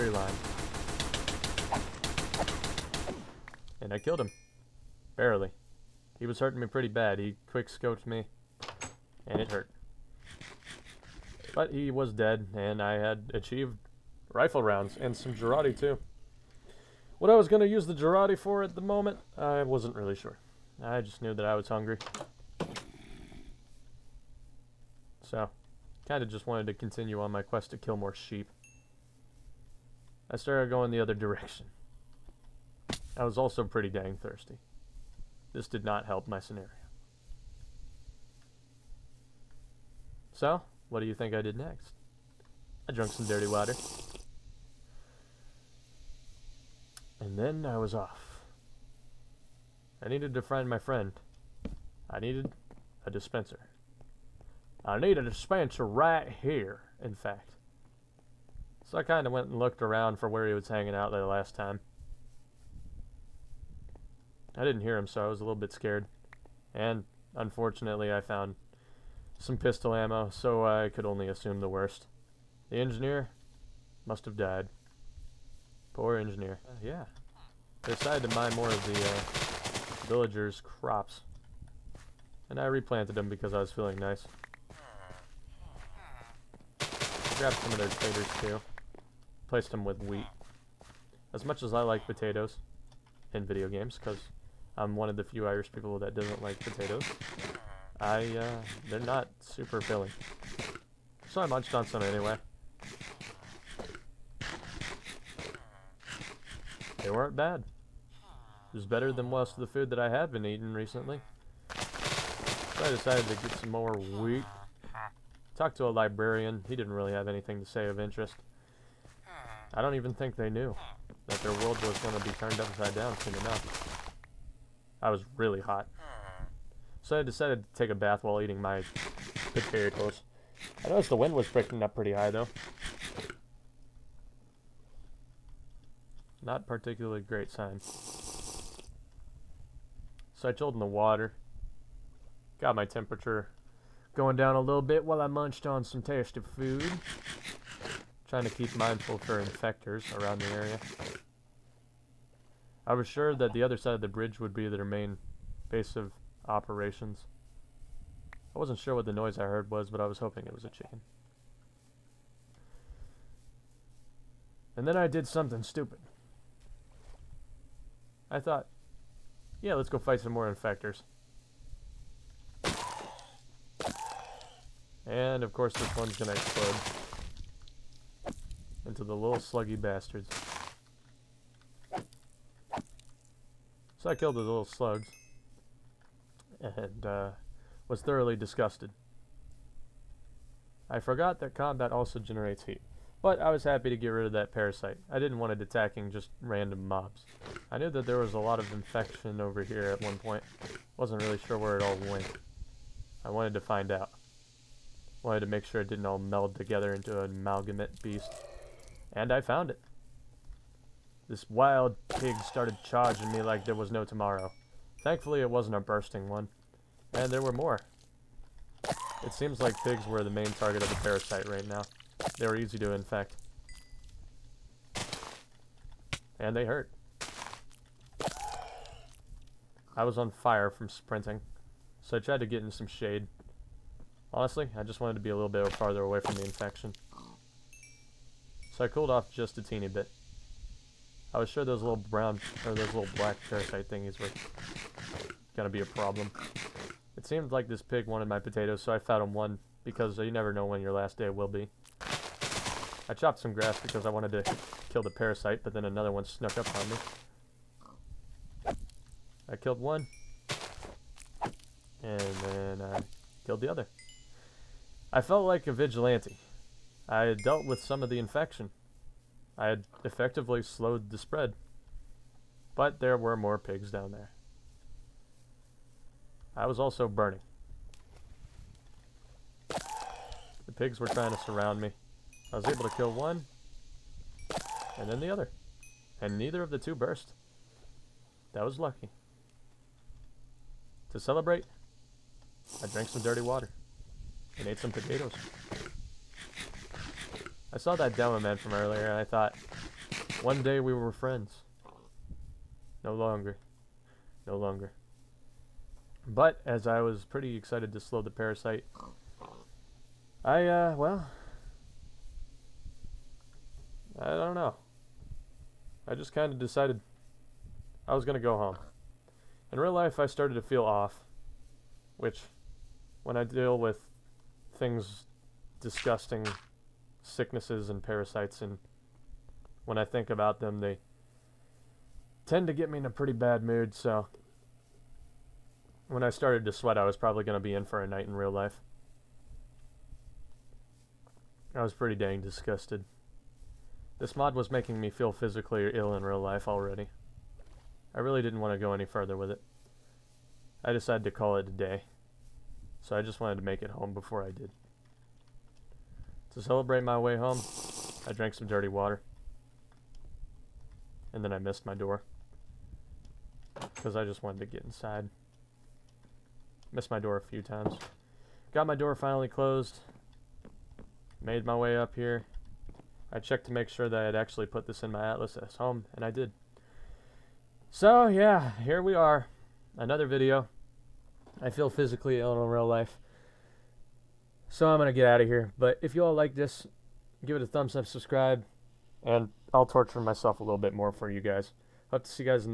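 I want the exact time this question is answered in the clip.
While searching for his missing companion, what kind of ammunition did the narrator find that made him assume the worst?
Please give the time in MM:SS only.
01:09.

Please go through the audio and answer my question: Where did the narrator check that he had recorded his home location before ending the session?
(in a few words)
atlas.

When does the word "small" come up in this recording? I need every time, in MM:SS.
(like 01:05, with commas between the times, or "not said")
not said.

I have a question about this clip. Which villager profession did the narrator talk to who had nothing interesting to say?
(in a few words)
librarian.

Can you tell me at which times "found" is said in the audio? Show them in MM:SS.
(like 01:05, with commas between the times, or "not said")
01:08, 03:29.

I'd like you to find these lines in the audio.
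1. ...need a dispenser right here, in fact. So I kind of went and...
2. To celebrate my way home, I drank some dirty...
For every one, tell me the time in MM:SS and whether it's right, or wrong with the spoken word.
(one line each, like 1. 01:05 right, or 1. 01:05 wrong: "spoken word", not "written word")
1. 00:54 right
2. 05:56 right.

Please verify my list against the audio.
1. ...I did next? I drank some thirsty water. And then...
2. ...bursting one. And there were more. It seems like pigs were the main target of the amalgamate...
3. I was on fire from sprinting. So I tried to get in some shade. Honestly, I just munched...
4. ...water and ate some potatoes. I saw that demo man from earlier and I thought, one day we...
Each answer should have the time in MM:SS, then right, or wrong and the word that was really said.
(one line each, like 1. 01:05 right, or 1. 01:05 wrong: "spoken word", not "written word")
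1. 00:41 wrong: "dirty", not "thirsty"
2. 03:35 wrong: "parasite", not "amalgamate"
3. 03:49 wrong: "wanted", not "munched"
4. 04:53 right.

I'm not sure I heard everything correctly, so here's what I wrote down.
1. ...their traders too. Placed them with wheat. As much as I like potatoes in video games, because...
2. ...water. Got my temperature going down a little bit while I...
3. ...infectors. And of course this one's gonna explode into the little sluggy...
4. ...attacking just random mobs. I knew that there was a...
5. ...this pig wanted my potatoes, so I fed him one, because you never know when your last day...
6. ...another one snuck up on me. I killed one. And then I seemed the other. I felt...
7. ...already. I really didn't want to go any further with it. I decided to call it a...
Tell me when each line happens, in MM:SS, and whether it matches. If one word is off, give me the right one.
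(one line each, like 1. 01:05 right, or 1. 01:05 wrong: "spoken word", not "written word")
1. 01:27 right
2. 02:20 right
3. 02:50 right
4. 03:15 right
5. 04:07 right
6. 04:15 wrong: "killed", not "seemed"
7. 05:46 right.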